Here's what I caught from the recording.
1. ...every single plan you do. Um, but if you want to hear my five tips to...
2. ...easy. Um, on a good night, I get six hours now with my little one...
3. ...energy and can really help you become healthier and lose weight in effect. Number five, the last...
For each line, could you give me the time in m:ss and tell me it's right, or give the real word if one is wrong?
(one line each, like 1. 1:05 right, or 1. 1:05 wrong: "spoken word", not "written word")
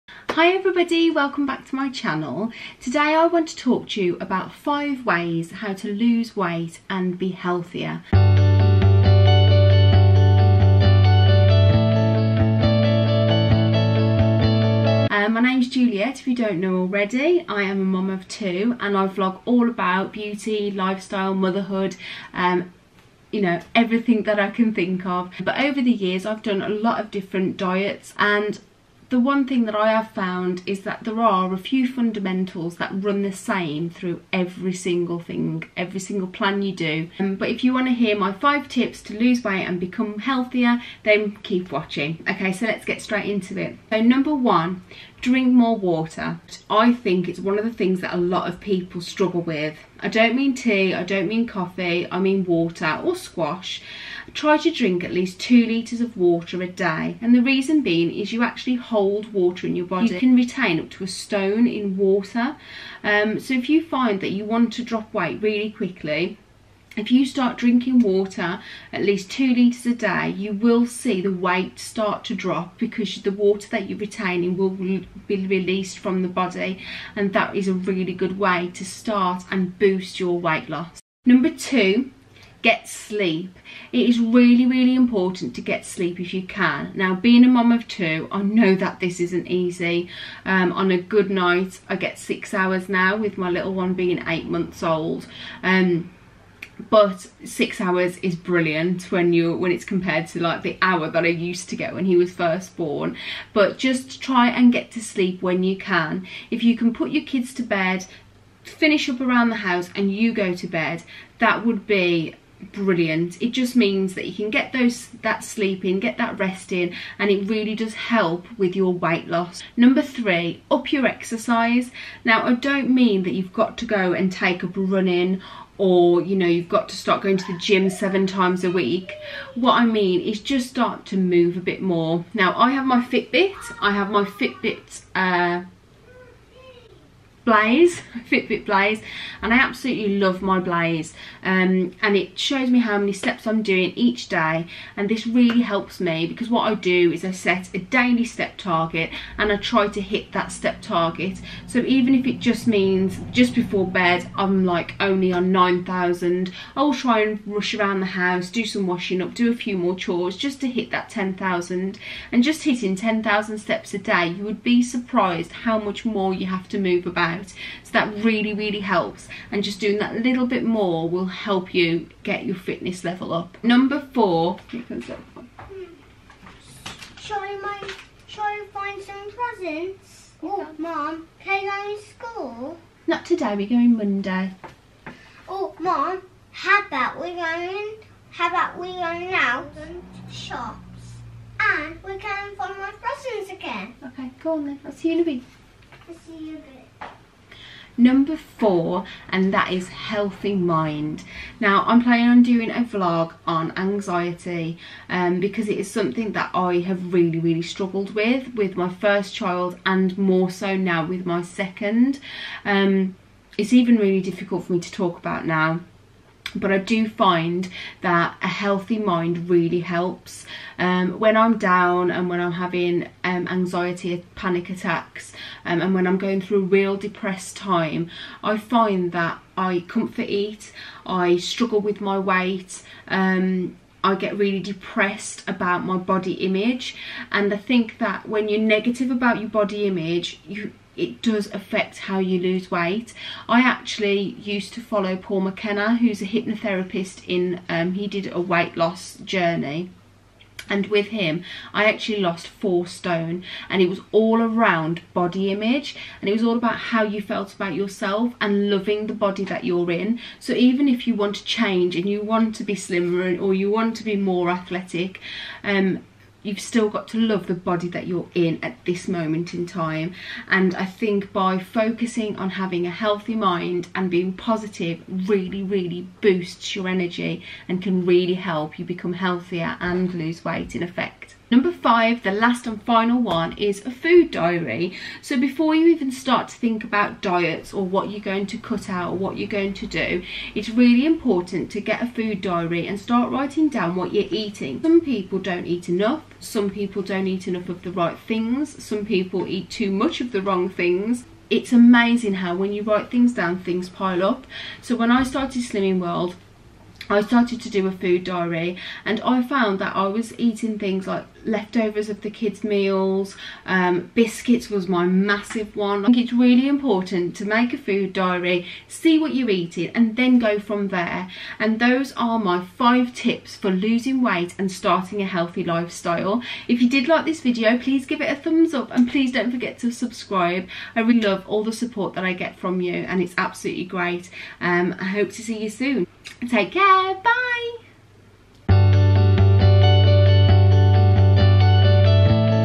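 1. 0:35 right
2. 1:29 right
3. 4:36 right.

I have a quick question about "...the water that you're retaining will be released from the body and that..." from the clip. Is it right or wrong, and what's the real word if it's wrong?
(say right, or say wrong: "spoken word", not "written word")
right.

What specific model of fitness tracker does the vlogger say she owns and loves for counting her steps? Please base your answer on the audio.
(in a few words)
Fitbit Blaze.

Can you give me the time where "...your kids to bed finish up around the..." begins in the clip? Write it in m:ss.
1:47.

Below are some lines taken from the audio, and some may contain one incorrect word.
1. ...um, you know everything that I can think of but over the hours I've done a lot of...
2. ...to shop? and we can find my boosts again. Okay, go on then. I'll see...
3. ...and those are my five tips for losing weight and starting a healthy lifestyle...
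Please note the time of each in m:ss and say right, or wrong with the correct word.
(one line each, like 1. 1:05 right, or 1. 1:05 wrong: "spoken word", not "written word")
1. 0:22 wrong: "years", not "hours"
2. 3:09 wrong: "presents", not "boosts"
3. 5:21 right.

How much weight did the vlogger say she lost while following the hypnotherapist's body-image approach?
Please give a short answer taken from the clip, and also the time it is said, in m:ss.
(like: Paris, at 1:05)
4 stone, at 4:12.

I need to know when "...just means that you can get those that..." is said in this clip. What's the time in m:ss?
1:53.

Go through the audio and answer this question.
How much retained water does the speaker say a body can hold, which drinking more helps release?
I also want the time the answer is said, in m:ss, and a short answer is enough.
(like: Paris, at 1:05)
a stone, at 1:01.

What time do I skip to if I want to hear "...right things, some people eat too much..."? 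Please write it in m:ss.
4:57.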